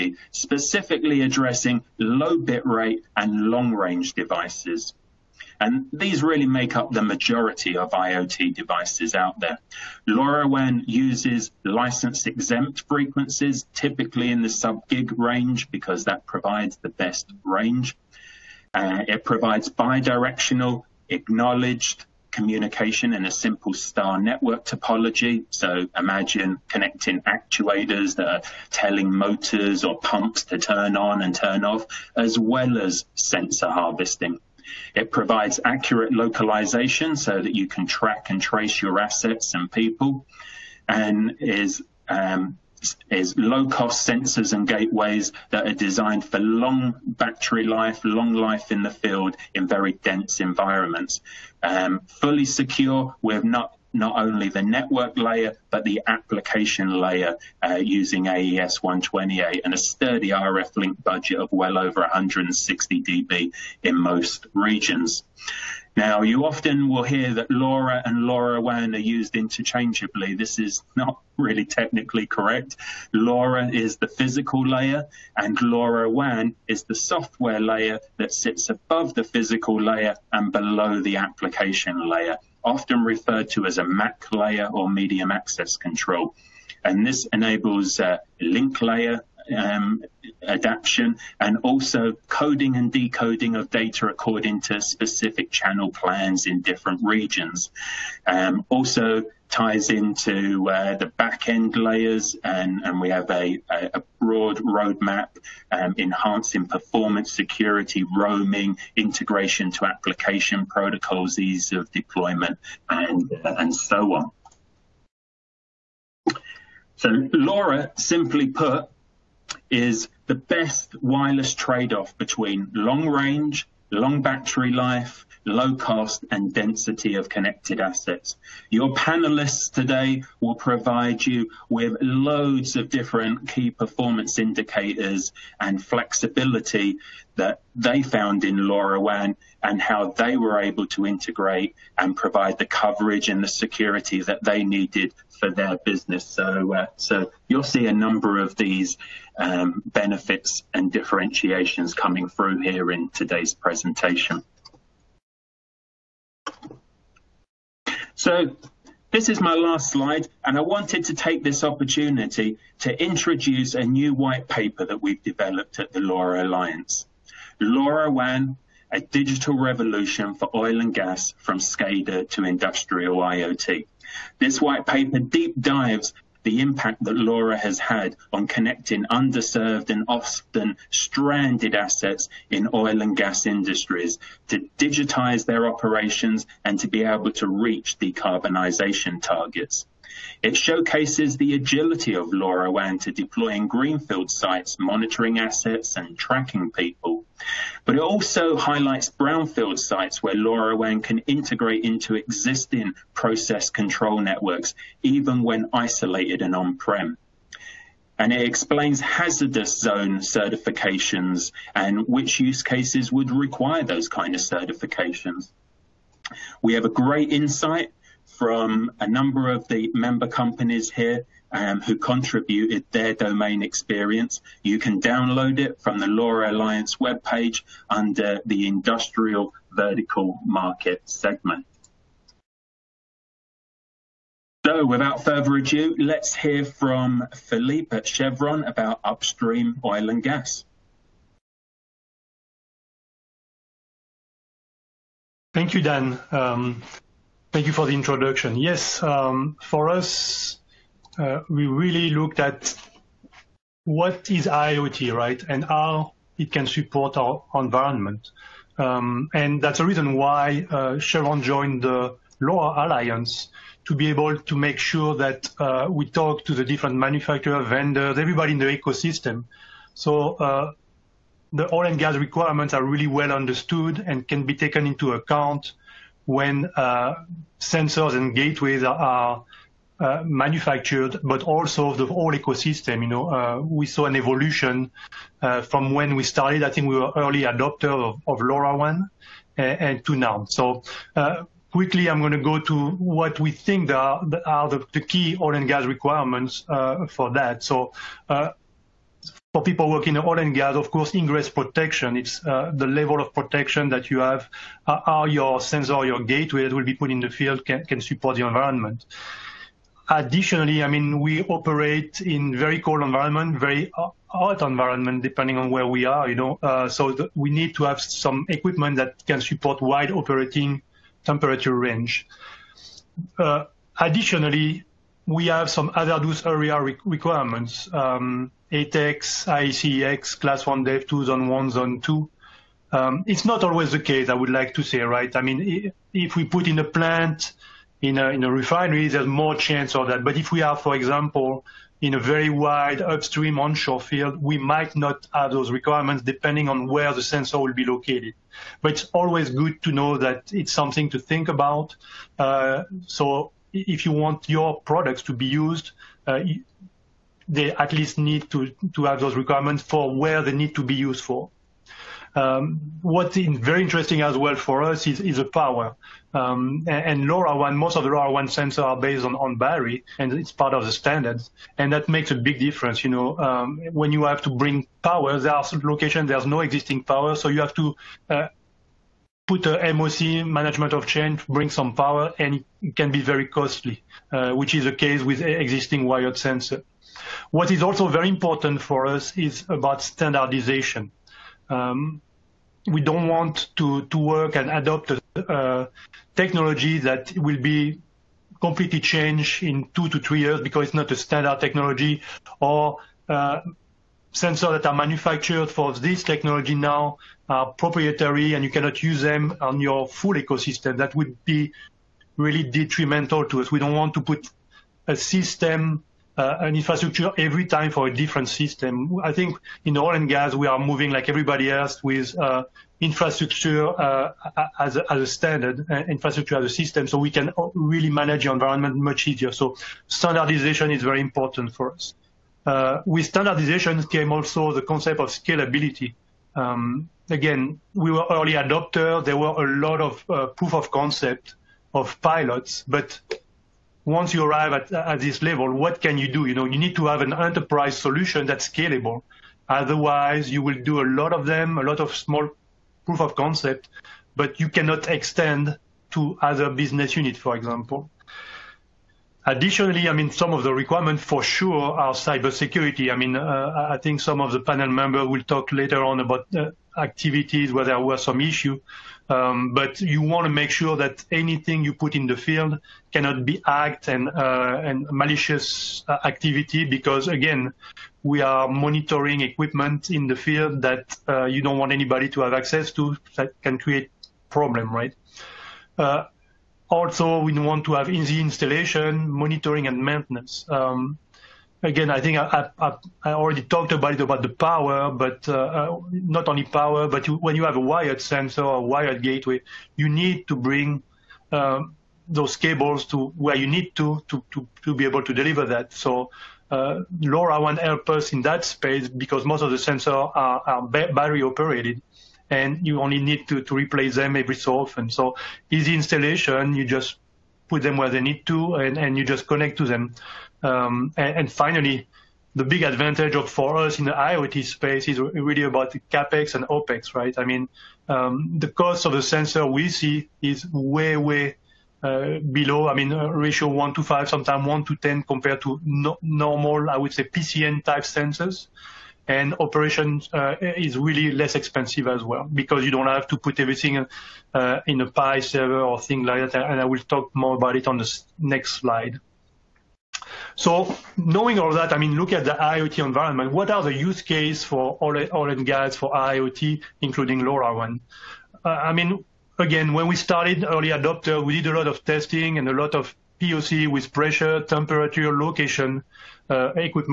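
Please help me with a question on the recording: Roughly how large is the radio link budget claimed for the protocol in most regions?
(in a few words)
over 160 dB.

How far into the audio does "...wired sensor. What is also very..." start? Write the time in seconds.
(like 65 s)
386 s.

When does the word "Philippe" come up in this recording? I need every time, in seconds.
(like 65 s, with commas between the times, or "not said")
237 s.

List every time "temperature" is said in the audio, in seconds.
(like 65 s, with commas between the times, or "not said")
321 s, 564 s.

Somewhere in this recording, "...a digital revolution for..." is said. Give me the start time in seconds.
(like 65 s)
168 s.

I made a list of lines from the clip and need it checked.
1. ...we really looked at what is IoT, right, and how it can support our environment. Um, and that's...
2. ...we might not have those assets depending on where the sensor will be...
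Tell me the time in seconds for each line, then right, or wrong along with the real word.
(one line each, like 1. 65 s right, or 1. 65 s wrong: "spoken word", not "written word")
1. 251 s right
2. 344 s wrong: "requirements", not "assets".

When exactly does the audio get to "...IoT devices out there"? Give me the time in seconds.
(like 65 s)
7 s.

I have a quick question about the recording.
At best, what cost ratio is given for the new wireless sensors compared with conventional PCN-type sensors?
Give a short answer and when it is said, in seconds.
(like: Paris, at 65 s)
1 to 10, at 534 s.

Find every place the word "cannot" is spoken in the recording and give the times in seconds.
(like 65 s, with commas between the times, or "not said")
408 s, 454 s, 473 s.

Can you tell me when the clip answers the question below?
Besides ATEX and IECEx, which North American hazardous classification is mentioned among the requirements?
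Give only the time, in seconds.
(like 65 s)
330 s.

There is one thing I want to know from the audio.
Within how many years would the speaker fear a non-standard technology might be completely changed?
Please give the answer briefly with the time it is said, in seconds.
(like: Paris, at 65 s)
2 to 3 years, at 399 s.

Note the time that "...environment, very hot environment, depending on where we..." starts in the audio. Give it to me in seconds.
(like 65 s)
313 s.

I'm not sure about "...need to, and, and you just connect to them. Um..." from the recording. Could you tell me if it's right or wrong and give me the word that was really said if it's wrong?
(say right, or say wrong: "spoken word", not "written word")
right.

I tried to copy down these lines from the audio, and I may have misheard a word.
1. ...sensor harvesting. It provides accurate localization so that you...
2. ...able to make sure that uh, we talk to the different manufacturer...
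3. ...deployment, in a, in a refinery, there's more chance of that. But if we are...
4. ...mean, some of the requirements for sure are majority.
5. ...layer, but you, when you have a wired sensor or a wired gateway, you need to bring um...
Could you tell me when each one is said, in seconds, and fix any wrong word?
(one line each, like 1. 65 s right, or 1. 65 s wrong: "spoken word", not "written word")
1. 33 s right
2. 264 s right
3. 336 s wrong: "plant", not "deployment"
4. 460 s wrong: "cybersecurity", not "majority"
5. 496 s wrong: "power", not "layer".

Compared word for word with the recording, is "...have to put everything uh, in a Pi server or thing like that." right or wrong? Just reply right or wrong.
right.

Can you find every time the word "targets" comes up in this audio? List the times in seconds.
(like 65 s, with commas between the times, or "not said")
189 s.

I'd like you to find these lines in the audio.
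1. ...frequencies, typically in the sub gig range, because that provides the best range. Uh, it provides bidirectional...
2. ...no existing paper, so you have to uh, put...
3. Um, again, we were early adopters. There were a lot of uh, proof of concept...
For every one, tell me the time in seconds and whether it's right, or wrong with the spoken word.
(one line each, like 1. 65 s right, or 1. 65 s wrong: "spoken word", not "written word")
1. 12 s right
2. 376 s wrong: "power", not "paper"
3. 436 s right.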